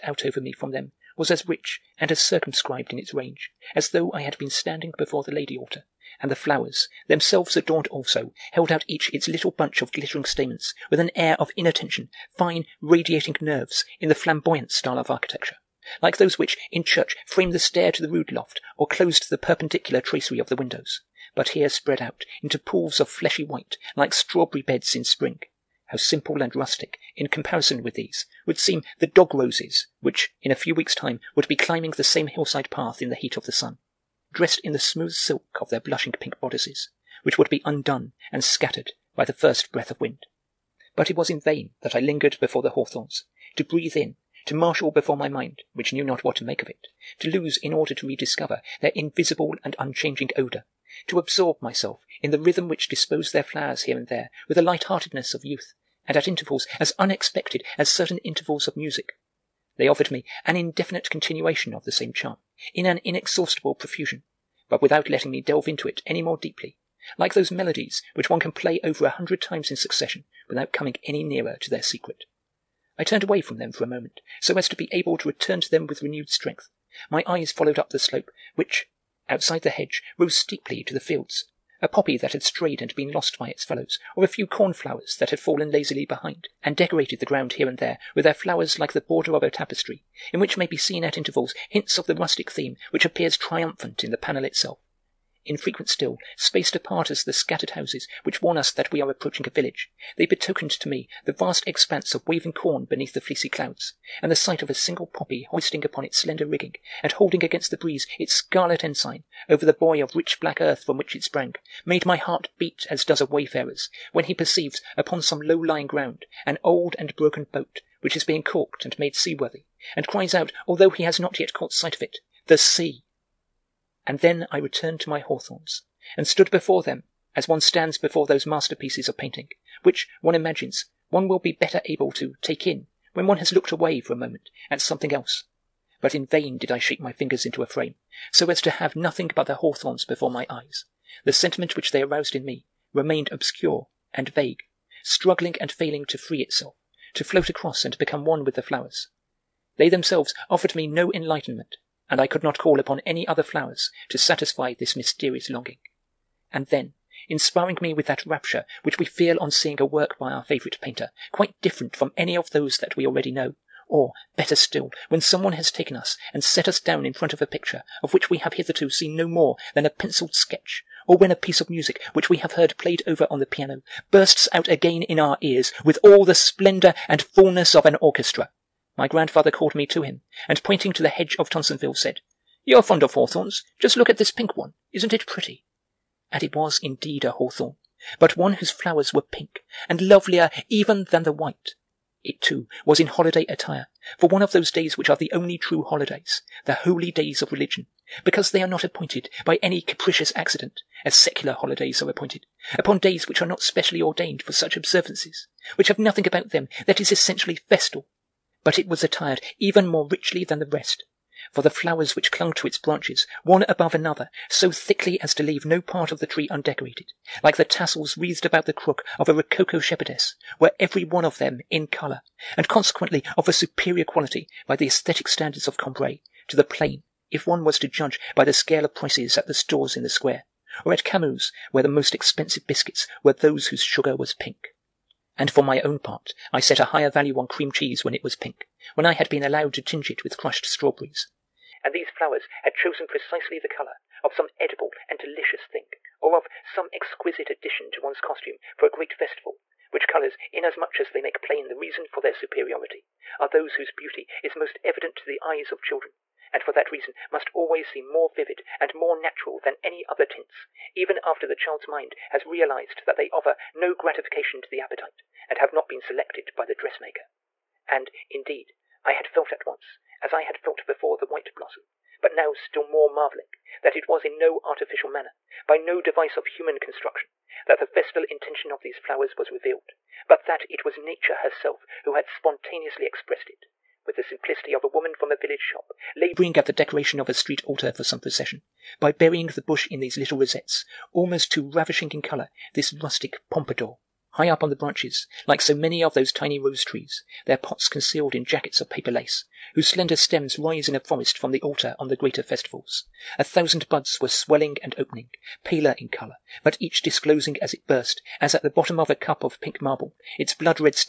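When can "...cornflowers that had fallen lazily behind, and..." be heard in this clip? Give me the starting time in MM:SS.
01:24.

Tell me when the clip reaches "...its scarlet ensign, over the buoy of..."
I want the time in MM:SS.
01:48.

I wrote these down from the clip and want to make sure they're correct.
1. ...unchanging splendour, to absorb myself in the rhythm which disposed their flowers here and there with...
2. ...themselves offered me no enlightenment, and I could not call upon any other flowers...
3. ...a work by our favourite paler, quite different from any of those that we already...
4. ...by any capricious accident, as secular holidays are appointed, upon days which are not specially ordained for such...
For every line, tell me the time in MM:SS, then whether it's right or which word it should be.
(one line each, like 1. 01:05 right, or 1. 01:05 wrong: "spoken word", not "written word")
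1. 00:49 wrong: "odour", not "splendour"
2. 02:29 right
3. 02:39 wrong: "painter", not "paler"
4. 03:19 right.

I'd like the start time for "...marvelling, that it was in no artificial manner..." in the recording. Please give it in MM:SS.
04:33.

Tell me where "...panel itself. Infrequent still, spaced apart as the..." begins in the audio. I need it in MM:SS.
01:34.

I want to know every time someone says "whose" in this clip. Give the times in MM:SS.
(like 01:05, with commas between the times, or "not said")
03:08, 03:53, 04:13, 04:59.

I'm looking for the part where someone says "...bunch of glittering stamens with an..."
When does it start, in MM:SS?
00:09.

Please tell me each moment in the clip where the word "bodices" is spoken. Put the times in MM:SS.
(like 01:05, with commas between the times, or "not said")
00:36.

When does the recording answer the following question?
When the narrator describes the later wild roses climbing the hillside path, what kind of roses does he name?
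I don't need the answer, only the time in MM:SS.
00:29.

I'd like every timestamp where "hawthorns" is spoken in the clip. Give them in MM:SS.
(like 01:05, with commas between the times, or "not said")
00:42, 02:05, 02:19, 03:03, 03:07.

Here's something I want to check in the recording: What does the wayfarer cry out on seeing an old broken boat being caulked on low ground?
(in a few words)
The sea!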